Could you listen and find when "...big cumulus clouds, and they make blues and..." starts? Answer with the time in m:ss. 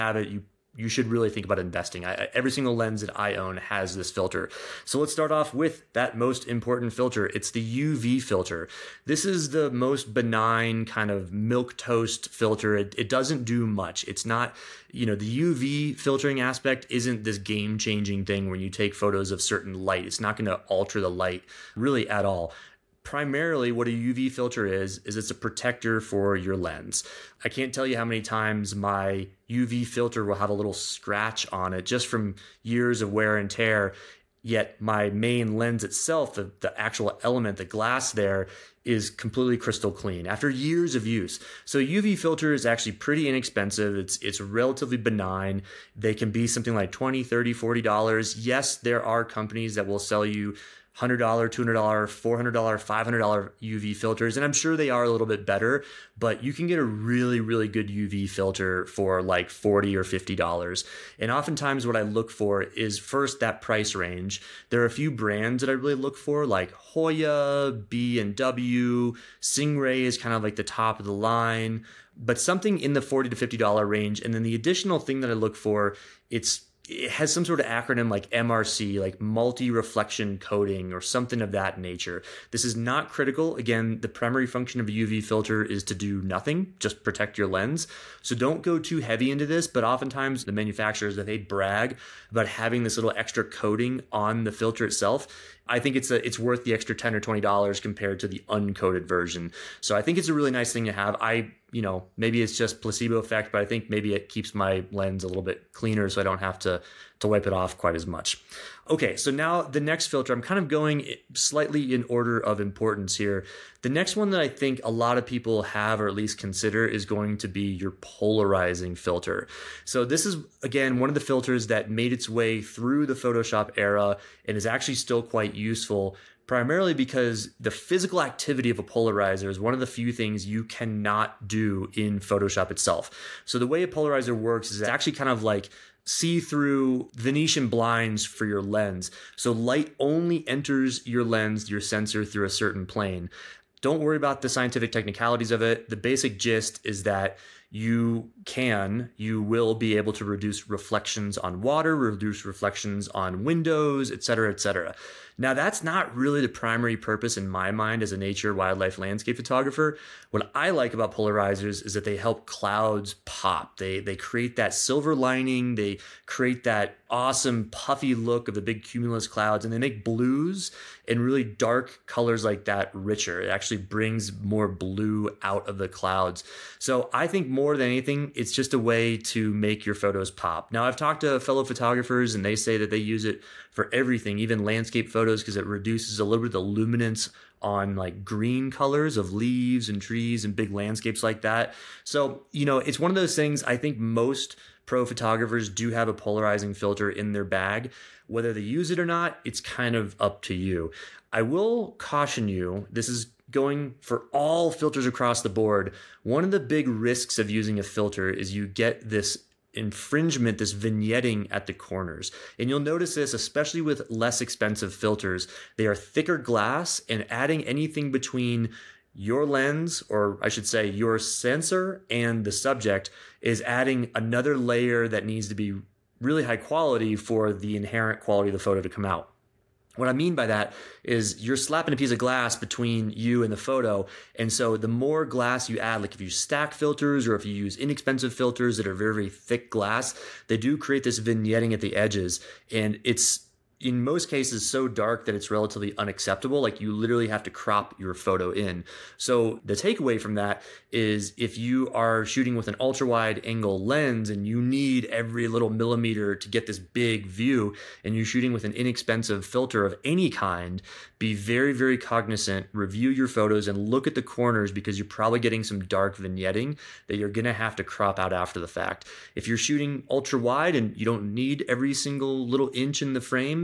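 2:48.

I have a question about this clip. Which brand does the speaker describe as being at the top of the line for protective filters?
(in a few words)
Singh-Ray.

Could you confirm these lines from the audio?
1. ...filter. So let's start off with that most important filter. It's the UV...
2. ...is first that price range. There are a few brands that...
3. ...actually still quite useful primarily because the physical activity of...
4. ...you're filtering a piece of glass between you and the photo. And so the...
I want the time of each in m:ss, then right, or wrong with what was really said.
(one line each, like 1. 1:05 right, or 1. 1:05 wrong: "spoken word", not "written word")
1. 0:04 right
2. 1:02 right
3. 2:04 right
4. 3:51 wrong: "slapping", not "filtering".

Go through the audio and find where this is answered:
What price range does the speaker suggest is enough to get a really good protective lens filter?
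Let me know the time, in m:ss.
0:59.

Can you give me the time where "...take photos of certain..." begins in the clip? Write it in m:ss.
0:18.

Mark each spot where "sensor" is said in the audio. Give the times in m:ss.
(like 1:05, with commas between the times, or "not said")
2:21, 3:41.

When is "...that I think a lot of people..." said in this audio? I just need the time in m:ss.
1:54.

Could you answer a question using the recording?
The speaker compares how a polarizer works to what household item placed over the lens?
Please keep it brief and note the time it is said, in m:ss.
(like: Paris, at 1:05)
Venetian blinds, at 2:17.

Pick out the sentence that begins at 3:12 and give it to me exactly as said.
So, you know, it's one of those things I think most pro photographers do have a polarizing filter in their bag.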